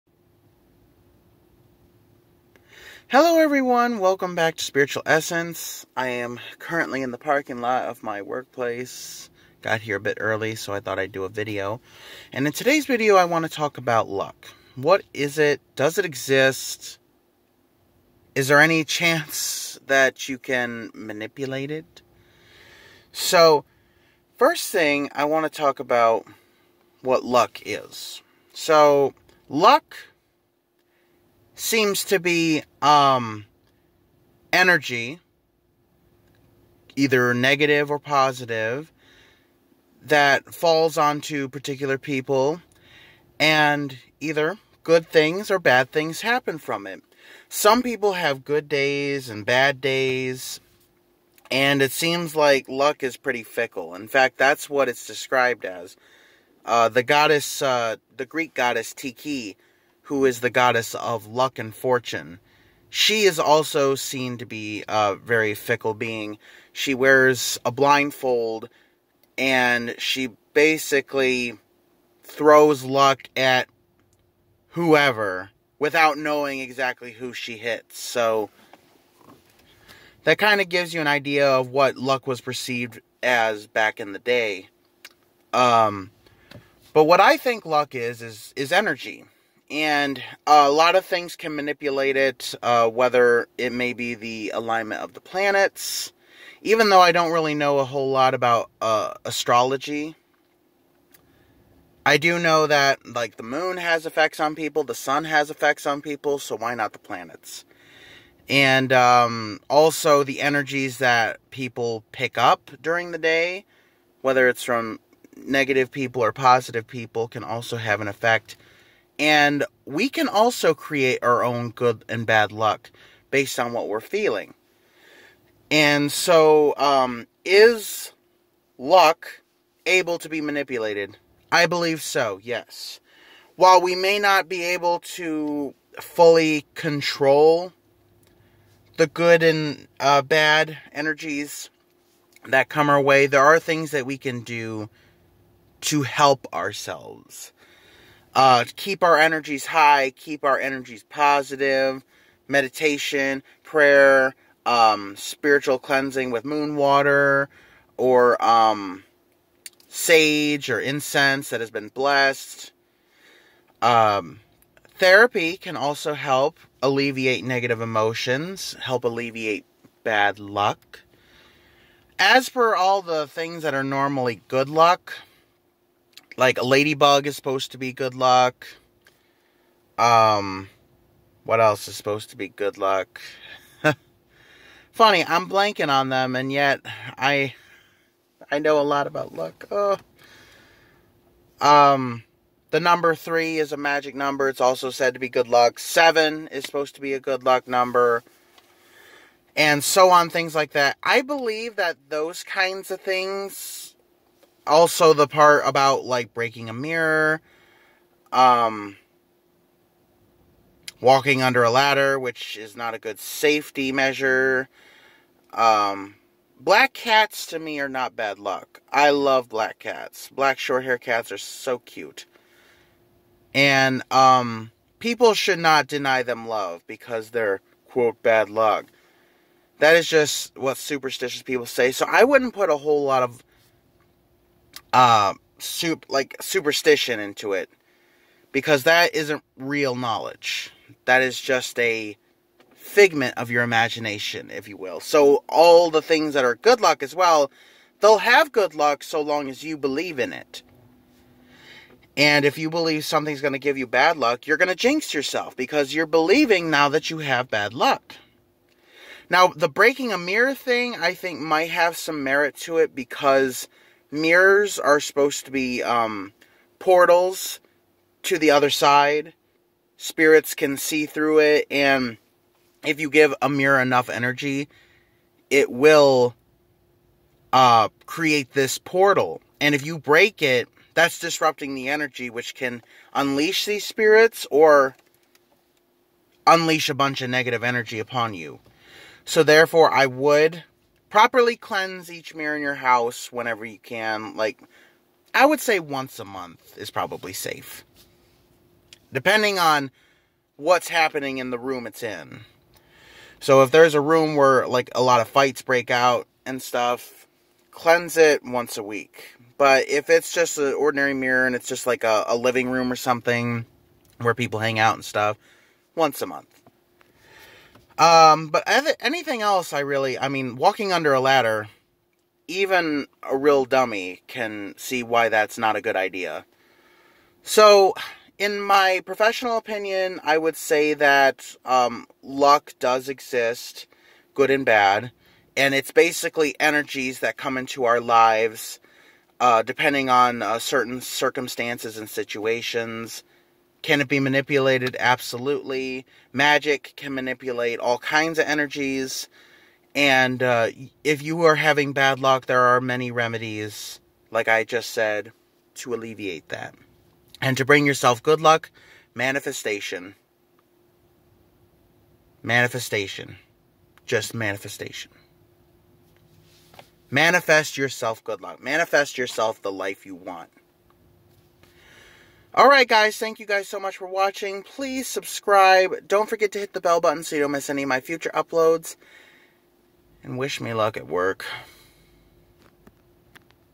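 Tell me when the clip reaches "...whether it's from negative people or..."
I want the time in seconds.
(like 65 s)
114 s.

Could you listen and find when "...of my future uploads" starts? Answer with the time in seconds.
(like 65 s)
377 s.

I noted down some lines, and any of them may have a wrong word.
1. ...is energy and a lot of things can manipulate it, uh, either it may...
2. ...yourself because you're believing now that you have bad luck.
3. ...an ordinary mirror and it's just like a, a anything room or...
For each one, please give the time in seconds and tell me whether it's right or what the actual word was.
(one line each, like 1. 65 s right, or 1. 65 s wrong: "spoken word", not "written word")
1. 88 s wrong: "whether", not "either"
2. 255 s right
3. 310 s wrong: "living", not "anything".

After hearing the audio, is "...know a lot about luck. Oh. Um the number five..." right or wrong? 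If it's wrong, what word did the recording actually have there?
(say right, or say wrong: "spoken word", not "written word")
wrong: "three", not "five".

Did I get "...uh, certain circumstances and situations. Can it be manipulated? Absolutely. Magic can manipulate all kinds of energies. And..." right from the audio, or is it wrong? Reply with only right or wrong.
right.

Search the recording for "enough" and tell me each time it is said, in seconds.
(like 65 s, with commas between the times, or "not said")
273 s.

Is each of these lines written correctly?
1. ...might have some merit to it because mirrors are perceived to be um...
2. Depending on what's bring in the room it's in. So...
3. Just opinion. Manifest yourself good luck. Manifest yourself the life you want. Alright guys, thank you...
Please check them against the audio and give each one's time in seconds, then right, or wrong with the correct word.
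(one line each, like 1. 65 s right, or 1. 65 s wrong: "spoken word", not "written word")
1. 261 s wrong: "supposed", not "perceived"
2. 299 s wrong: "happening", not "bring"
3. 364 s wrong: "manifestation", not "opinion".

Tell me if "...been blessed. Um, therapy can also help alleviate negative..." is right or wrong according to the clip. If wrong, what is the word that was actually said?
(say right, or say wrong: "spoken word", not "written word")
right.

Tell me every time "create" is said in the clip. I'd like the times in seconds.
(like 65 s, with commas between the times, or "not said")
120 s, 278 s.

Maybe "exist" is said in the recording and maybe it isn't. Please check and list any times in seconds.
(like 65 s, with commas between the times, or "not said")
16 s, 333 s.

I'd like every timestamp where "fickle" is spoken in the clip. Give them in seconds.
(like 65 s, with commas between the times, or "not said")
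53 s, 65 s.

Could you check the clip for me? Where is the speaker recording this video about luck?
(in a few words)
Parking lot of my workplace.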